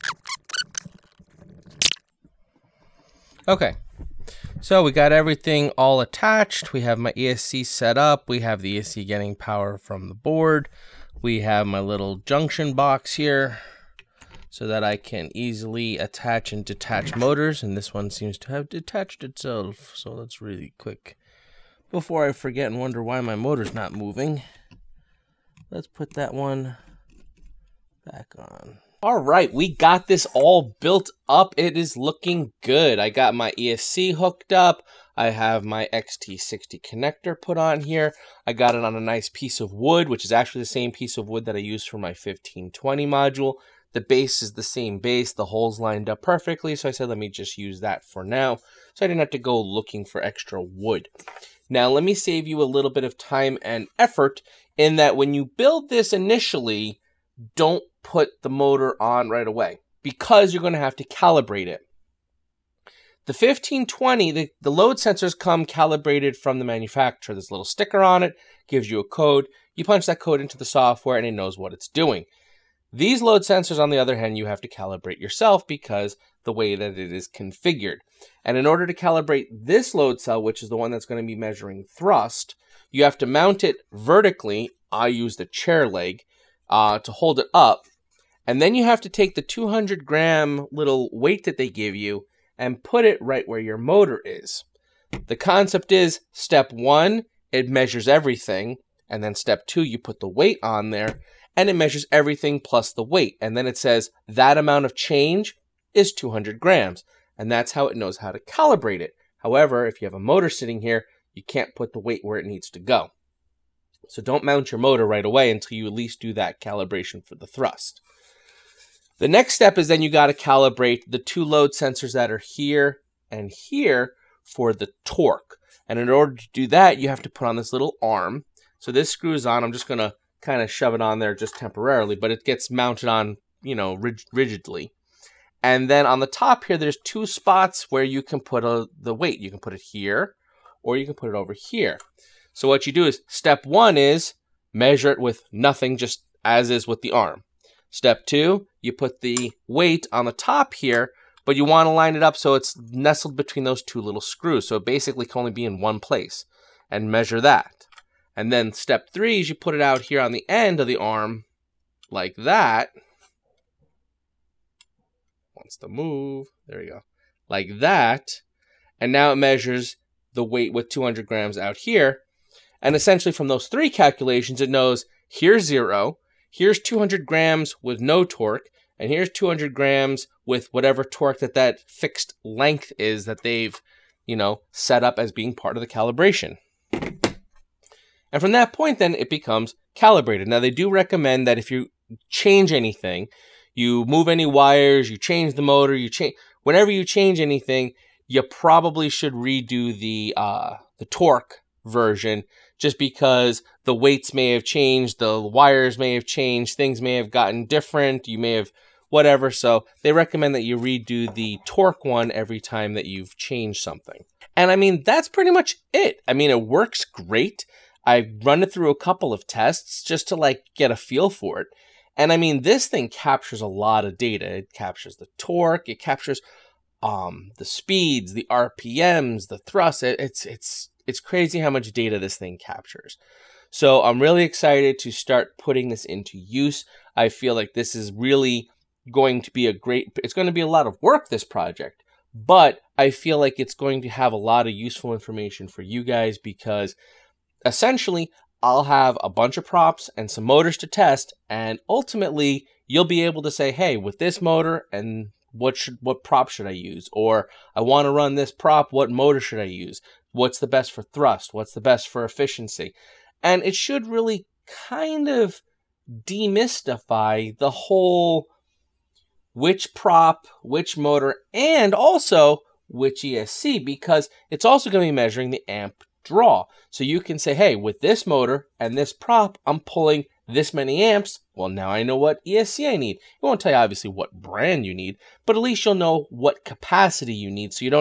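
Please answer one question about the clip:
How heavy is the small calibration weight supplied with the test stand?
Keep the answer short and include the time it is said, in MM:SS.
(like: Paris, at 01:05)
200 grams, at 01:29.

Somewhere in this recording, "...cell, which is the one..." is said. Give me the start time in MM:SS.
01:20.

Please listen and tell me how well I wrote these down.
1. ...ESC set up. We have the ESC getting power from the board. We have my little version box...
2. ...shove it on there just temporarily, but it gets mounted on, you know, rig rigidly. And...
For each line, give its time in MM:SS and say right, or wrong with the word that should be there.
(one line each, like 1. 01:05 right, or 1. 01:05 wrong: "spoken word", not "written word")
1. 00:07 wrong: "junction", not "version"
2. 02:10 right.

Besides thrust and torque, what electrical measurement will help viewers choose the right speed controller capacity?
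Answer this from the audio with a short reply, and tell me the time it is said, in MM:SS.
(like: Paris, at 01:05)
amp draw, at 04:35.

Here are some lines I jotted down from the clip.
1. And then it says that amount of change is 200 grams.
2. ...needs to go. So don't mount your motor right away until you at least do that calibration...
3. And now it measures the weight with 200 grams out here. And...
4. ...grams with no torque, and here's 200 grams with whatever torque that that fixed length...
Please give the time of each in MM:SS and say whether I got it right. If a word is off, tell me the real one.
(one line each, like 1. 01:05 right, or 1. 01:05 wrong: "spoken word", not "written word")
1. 01:43 right
2. 01:52 right
3. 02:49 right
4. 02:57 right.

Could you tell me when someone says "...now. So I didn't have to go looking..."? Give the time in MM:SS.
00:48.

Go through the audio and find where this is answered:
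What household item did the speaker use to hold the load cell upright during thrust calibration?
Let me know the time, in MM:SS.
01:25.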